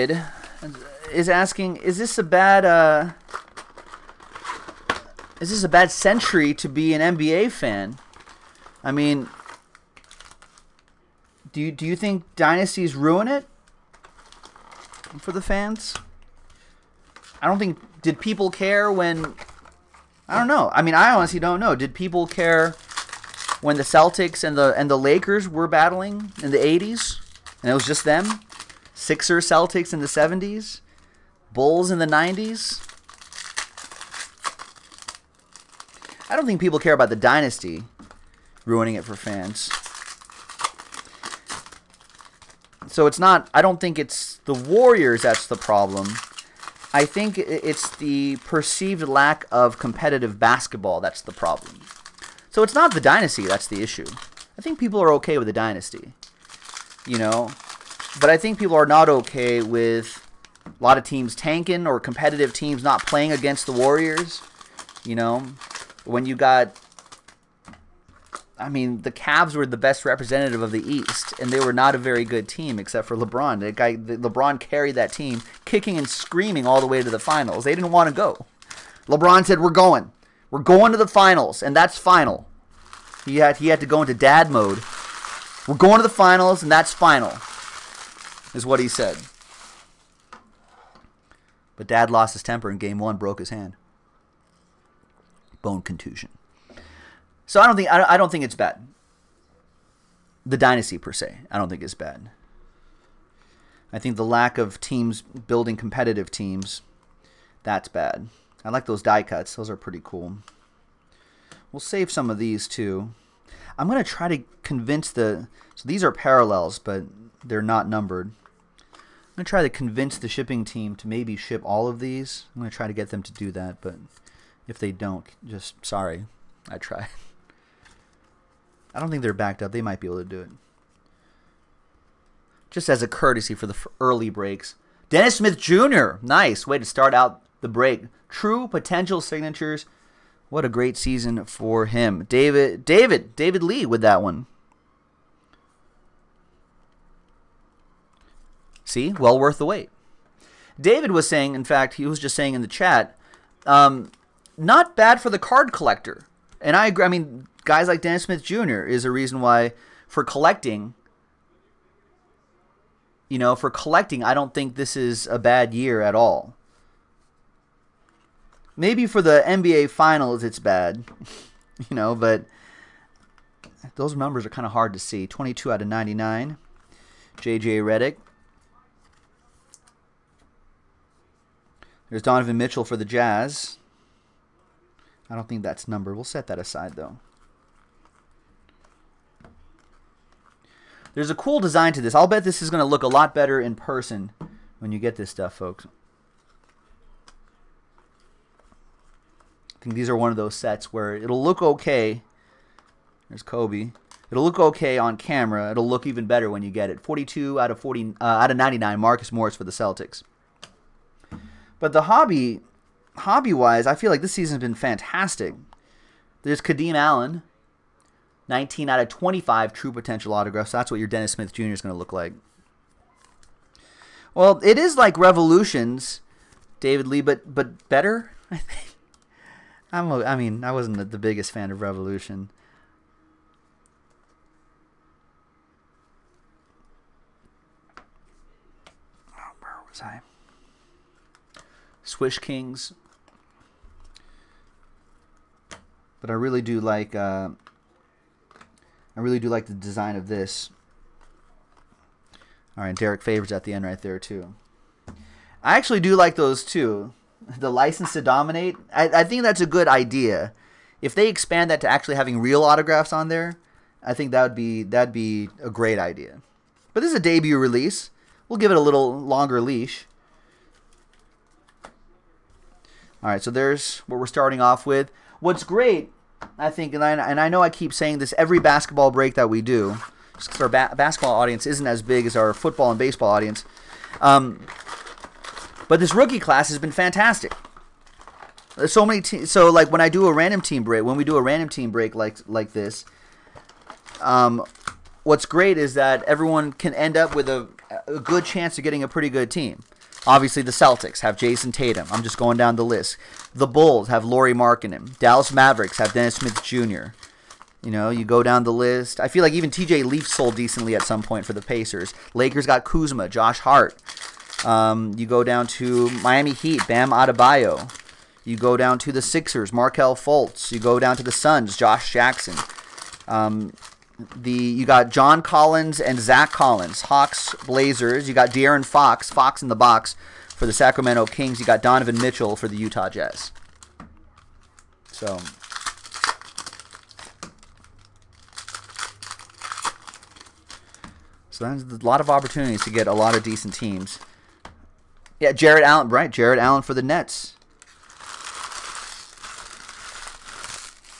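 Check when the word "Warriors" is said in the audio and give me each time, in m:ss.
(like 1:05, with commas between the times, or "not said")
0:44, 1:03.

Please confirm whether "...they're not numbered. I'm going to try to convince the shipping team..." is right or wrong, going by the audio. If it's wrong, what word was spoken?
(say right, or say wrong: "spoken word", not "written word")
right.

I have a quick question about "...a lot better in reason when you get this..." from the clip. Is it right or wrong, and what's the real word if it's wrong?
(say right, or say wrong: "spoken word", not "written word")
wrong: "person", not "reason".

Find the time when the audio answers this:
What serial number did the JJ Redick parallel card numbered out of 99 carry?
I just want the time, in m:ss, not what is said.
2:55.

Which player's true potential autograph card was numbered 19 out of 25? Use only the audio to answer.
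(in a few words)
Kadeem Allen.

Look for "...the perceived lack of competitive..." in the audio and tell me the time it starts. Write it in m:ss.
0:47.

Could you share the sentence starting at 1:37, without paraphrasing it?
So I don't think I don't think it's bad.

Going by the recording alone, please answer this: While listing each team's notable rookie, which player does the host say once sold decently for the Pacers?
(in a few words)
TJ Leaf.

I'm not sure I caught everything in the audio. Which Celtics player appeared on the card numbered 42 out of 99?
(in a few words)
Marcus Morris.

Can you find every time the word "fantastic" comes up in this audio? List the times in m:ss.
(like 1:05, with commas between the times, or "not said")
3:34, 4:46.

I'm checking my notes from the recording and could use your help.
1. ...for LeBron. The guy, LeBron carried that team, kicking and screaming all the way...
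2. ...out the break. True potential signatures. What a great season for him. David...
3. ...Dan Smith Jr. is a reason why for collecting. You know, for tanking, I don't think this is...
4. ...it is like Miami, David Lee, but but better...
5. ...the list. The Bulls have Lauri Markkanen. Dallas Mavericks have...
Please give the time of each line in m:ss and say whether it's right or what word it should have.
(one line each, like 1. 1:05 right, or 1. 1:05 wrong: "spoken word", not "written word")
1. 1:13 right
2. 2:17 right
3. 2:37 wrong: "collecting", not "tanking"
4. 3:44 wrong: "Revolutions", not "Miami"
5. 5:02 right.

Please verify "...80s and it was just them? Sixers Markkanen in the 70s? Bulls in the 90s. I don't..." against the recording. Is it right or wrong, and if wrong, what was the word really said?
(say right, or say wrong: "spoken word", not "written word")
wrong: "Celtics", not "Markkanen".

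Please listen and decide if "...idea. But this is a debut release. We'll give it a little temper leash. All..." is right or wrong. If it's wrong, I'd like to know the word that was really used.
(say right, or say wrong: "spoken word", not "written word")
wrong: "longer", not "temper".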